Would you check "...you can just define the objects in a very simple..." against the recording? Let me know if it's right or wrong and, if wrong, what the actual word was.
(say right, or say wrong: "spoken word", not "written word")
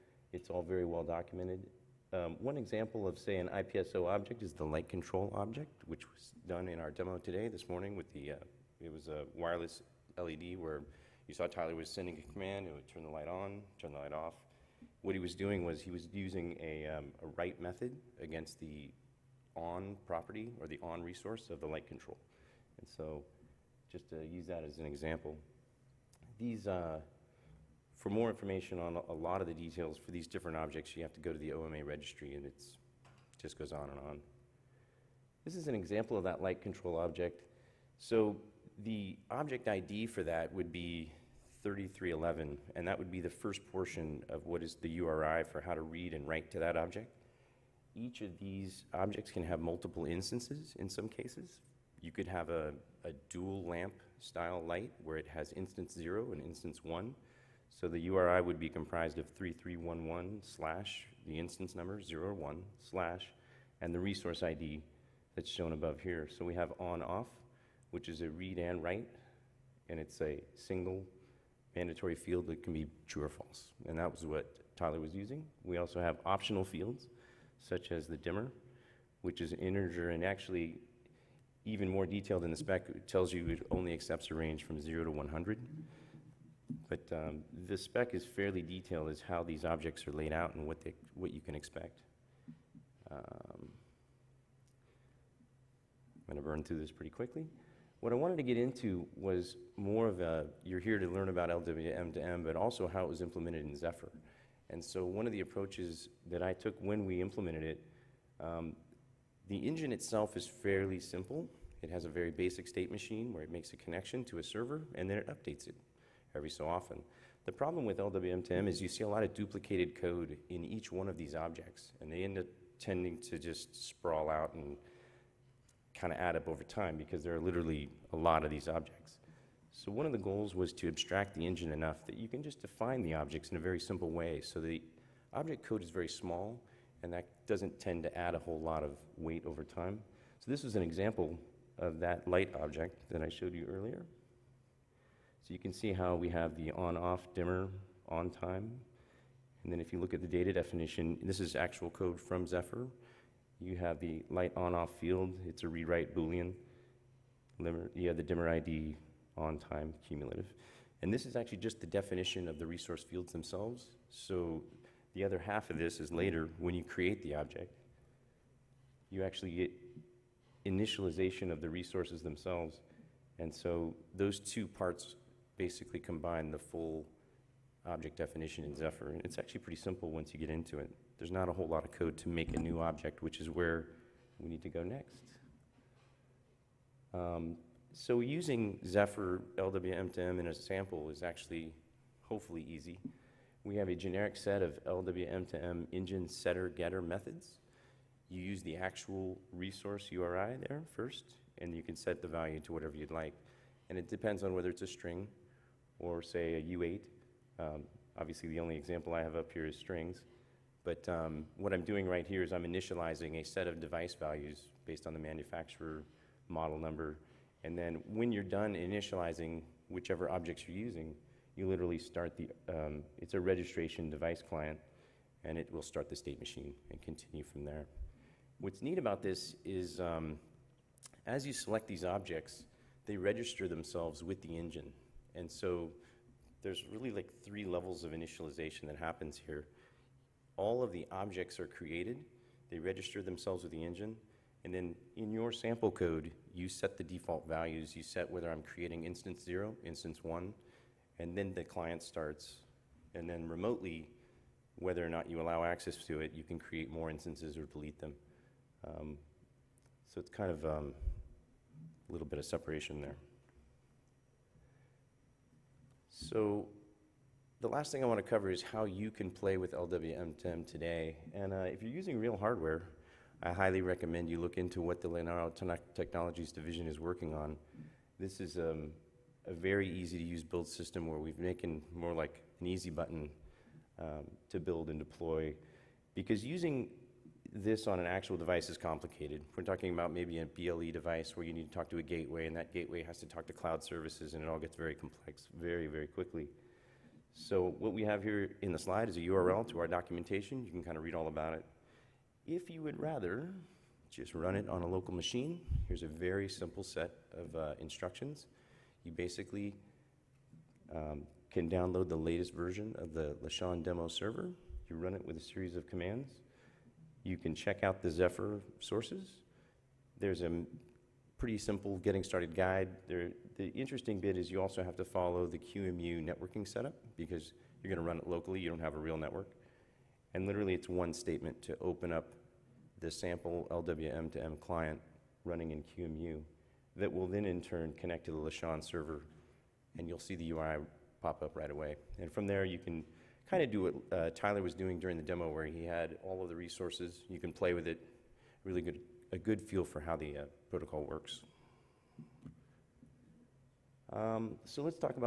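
right.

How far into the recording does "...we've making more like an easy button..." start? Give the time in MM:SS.
04:41.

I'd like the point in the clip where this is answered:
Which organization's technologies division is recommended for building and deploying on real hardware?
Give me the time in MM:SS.
04:35.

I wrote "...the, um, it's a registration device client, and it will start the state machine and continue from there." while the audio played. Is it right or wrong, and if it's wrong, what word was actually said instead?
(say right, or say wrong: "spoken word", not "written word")
right.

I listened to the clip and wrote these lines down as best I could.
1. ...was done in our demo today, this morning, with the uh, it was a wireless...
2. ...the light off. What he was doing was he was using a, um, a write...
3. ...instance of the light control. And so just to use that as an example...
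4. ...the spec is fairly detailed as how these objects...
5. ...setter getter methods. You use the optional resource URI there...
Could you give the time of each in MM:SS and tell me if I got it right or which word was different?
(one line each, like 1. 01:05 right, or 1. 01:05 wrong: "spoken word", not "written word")
1. 00:06 right
2. 00:13 right
3. 00:21 wrong: "resource", not "instance"
4. 01:27 right
5. 03:16 wrong: "actual", not "optional".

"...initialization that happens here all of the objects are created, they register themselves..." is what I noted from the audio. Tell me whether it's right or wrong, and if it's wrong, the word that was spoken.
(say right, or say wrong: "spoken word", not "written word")
right.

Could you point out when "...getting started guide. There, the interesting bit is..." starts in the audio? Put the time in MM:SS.
05:21.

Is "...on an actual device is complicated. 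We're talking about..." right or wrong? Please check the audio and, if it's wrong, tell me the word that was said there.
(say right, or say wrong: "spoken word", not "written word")
right.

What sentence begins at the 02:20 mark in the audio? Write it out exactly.
So this is an example of that light object that I showed you earlier.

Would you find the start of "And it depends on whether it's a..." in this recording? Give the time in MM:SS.
03:23.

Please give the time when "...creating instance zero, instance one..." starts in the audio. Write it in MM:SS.
04:08.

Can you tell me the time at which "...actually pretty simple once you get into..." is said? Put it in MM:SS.
02:59.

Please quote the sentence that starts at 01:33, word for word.
Um, I'm going to burn through this pretty quickly.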